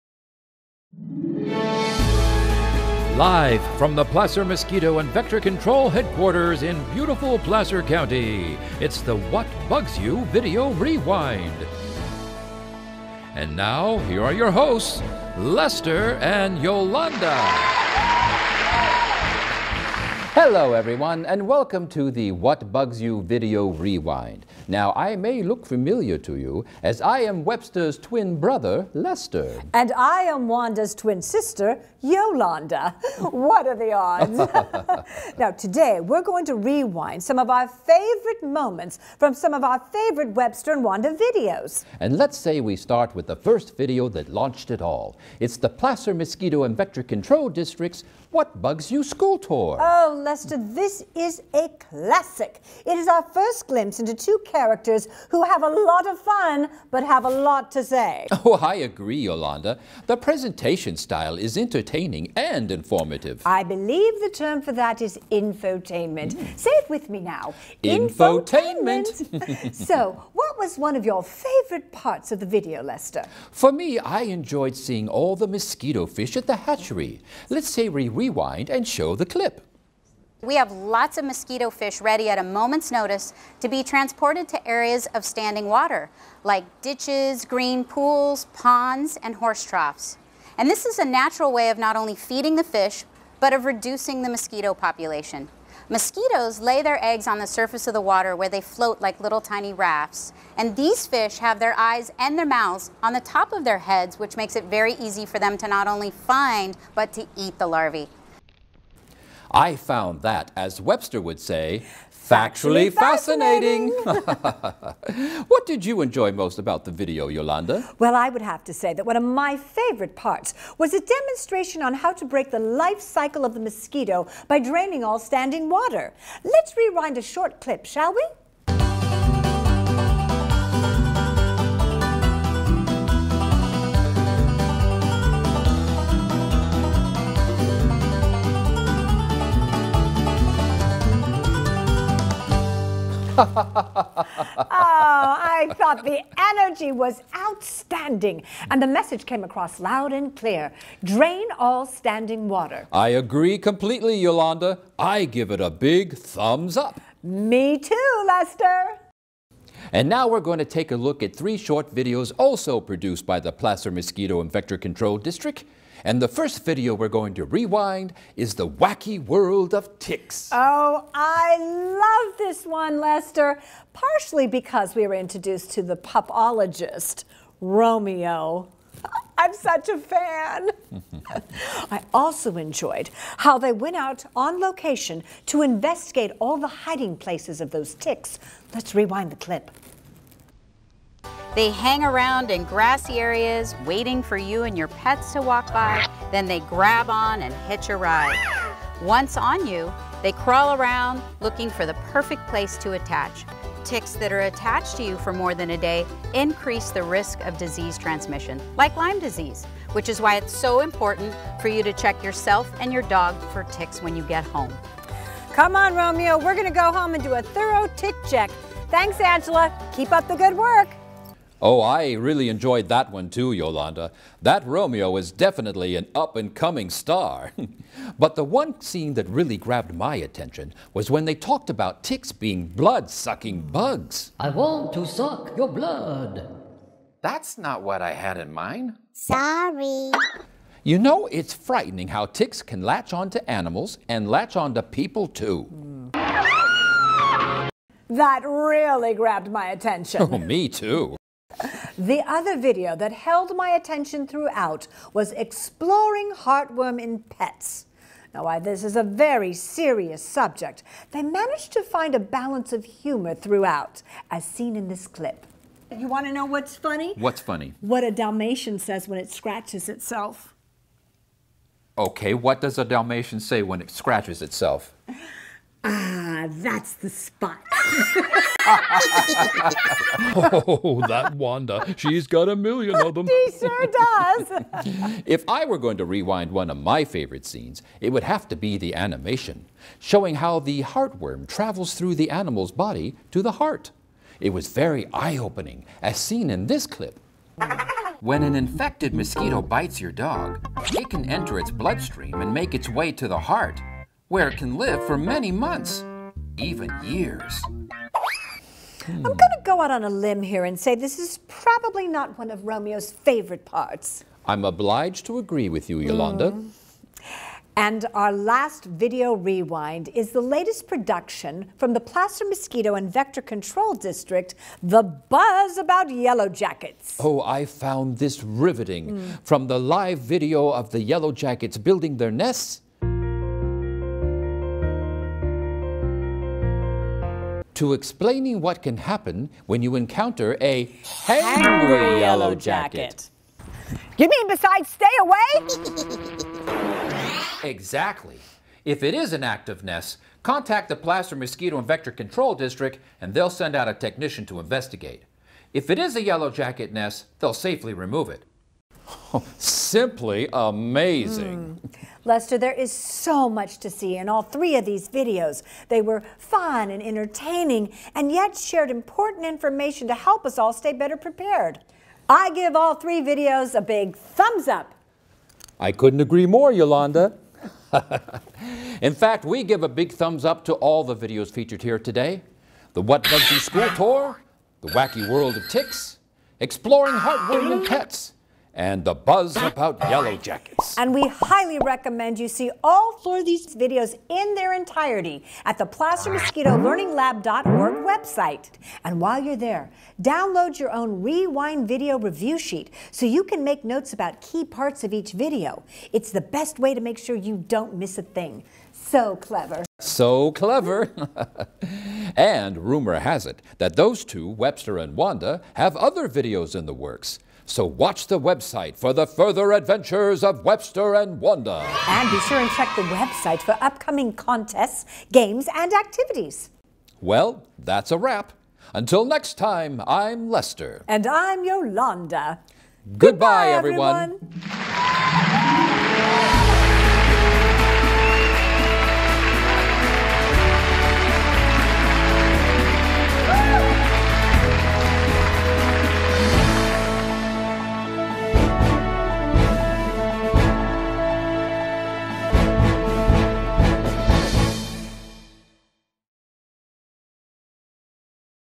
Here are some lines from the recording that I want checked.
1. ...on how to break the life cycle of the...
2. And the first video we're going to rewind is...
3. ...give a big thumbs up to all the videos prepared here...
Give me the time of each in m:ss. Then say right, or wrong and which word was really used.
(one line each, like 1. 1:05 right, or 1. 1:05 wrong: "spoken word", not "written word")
1. 2:01 right
2. 2:46 right
3. 6:19 wrong: "featured", not "prepared".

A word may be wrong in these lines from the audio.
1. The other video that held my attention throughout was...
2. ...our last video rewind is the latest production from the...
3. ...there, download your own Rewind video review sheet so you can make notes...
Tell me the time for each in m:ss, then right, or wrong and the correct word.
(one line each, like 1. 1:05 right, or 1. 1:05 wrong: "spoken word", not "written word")
1. 4:11 right
2. 5:18 right
3. 6:39 right.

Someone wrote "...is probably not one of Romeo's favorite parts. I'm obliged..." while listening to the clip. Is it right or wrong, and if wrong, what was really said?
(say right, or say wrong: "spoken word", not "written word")
right.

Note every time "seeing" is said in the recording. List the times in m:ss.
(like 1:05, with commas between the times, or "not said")
1:14.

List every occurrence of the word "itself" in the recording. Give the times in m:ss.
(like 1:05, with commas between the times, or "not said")
4:29, 4:34.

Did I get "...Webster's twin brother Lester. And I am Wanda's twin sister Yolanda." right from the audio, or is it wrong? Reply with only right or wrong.
right.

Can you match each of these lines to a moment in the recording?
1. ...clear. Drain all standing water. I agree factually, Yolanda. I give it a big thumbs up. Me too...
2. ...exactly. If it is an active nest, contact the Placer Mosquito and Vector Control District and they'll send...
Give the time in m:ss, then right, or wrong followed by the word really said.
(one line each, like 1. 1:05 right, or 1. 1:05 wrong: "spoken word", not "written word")
1. 2:30 wrong: "completely", not "factually"
2. 5:47 right.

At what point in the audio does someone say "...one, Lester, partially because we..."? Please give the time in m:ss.
2:52.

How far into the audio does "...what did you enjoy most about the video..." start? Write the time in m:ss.
1:55.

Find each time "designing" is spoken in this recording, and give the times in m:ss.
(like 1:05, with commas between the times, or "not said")
not said.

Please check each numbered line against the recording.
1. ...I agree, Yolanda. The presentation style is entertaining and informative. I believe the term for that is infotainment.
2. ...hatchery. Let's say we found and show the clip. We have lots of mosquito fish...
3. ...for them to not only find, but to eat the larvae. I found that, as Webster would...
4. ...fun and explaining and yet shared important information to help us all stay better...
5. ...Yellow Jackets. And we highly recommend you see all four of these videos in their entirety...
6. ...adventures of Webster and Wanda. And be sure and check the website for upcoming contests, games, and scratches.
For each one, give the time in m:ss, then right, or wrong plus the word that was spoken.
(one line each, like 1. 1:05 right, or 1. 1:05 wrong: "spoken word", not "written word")
1. 0:58 right
2. 1:16 wrong: "rewind", not "found"
3. 1:45 right
4. 6:06 wrong: "entertaining", not "explaining"
5. 6:30 right
6. 6:59 wrong: "activities", not "scratches".